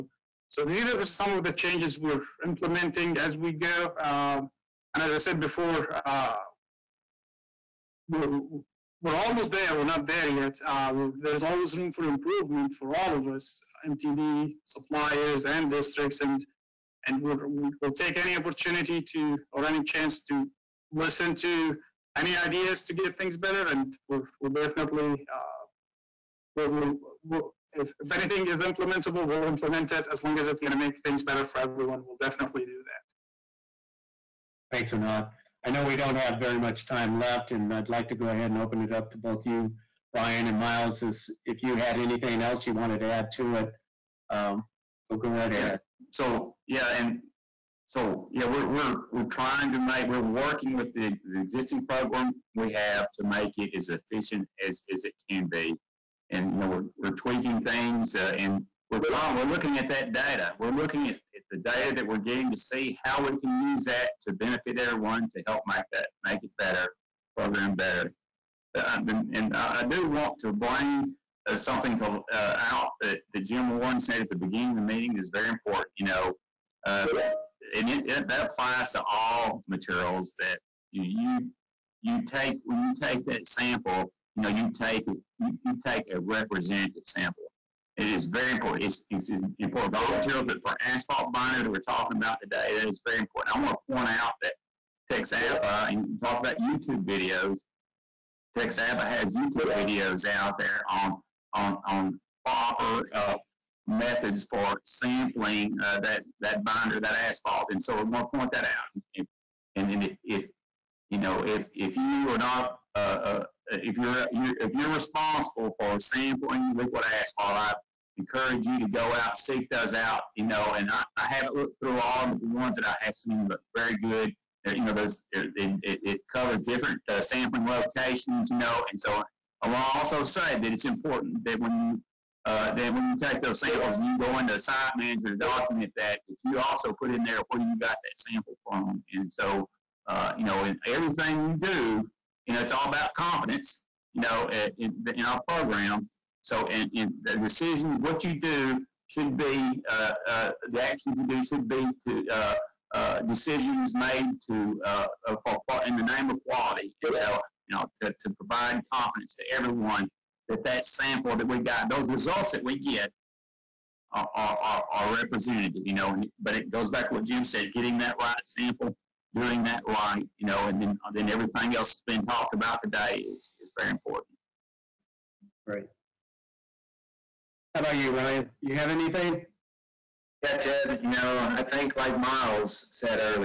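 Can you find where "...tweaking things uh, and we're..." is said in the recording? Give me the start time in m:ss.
0:57.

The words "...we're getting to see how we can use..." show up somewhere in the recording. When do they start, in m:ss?
1:02.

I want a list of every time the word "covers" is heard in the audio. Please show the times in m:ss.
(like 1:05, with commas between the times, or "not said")
2:06.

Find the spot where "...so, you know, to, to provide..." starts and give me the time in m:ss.
2:37.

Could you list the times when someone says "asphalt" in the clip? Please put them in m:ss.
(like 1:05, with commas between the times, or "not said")
1:30, 1:47, 1:57.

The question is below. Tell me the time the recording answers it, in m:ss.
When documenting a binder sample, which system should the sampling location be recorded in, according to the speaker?
2:14.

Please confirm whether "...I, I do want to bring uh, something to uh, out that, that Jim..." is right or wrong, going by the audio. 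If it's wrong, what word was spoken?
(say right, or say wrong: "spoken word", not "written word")
right.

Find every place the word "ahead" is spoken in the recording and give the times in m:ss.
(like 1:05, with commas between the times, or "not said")
0:38, 0:45.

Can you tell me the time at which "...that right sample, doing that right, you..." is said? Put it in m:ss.
2:47.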